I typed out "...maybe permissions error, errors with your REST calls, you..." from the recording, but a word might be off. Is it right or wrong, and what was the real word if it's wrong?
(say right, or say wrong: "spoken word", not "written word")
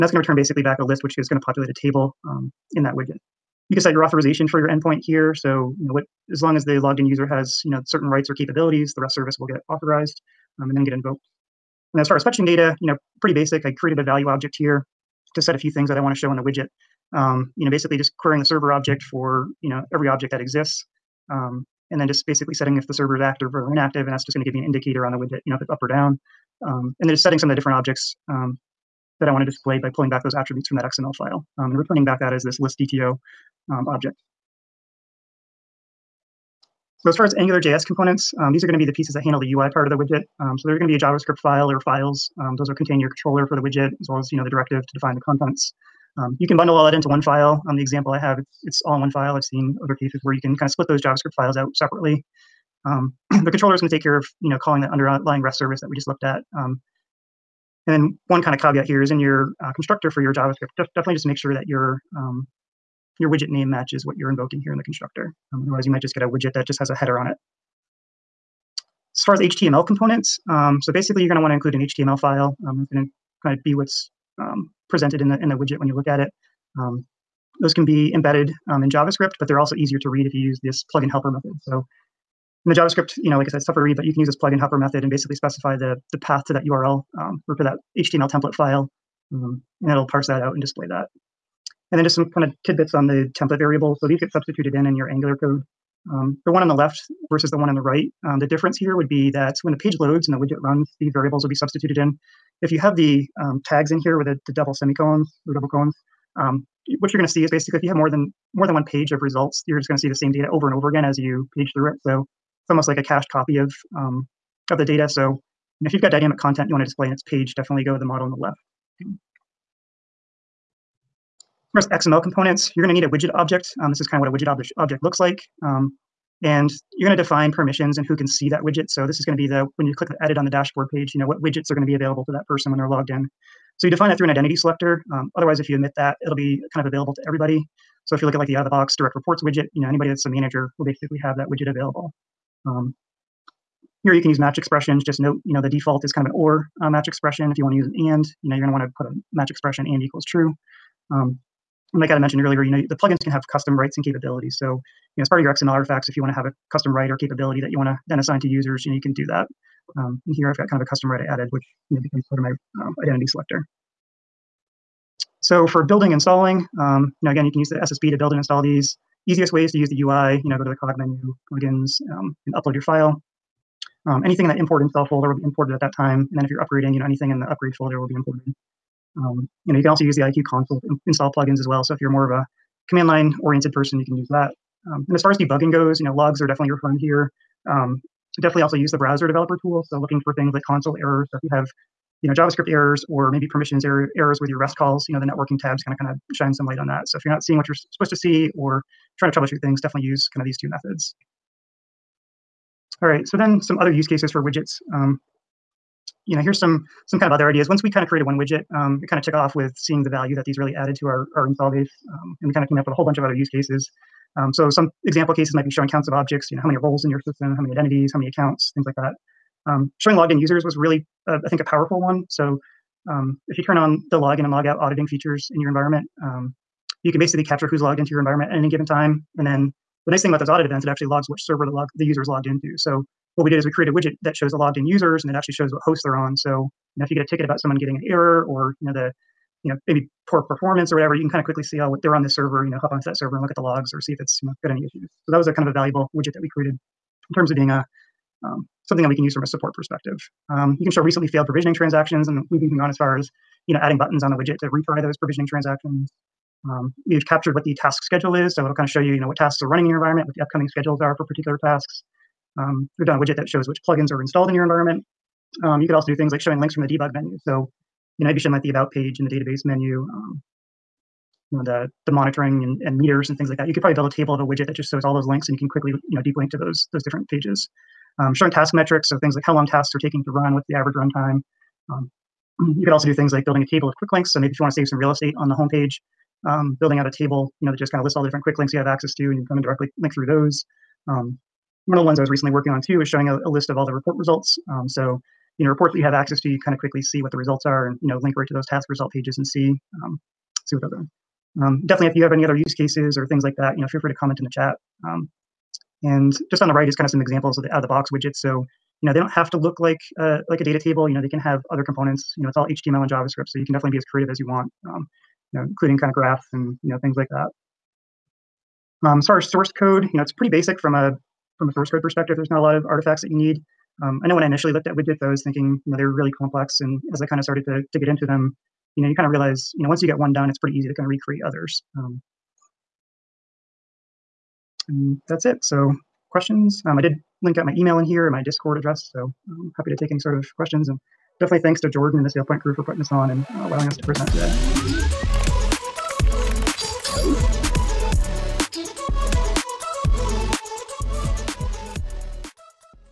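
right.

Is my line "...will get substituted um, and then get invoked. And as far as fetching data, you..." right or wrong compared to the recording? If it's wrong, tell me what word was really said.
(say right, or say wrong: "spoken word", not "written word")
wrong: "authorized", not "substituted".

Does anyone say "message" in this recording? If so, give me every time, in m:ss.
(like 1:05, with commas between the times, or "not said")
not said.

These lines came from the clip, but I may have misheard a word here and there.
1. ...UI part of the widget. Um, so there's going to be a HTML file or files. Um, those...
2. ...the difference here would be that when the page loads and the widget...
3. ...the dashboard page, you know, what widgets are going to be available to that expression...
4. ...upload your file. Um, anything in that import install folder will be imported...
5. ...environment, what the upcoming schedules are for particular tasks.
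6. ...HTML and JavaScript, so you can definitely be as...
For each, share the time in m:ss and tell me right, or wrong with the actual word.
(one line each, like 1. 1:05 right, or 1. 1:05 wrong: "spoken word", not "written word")
1. 0:39 wrong: "JavaScript", not "HTML"
2. 1:38 right
3. 2:10 wrong: "person", not "expression"
4. 2:52 right
5. 4:19 right
6. 5:12 right.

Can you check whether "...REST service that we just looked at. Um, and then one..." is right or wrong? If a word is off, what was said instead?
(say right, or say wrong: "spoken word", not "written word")
right.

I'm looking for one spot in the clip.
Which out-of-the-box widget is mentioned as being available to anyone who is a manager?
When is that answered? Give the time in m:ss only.
2:18.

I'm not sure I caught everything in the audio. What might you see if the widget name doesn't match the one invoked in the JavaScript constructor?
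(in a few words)
a widget that just has a header.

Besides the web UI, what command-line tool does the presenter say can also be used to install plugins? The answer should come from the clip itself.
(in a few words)
IIQ console.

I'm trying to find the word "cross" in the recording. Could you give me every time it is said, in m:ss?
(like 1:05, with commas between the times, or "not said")
not said.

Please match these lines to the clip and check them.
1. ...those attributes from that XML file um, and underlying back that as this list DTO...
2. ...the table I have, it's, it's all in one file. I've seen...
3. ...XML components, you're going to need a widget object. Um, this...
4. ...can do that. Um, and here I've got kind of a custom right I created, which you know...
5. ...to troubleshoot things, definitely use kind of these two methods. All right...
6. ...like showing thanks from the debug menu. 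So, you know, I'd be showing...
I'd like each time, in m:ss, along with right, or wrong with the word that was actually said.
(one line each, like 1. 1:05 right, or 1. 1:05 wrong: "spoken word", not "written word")
1. 0:30 wrong: "returning", not "underlying"
2. 0:47 wrong: "example", not "table"
3. 2:02 right
4. 2:39 wrong: "added", not "created"
5. 3:19 right
6. 4:26 wrong: "links", not "thanks".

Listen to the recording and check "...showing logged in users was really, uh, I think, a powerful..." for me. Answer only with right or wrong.
right.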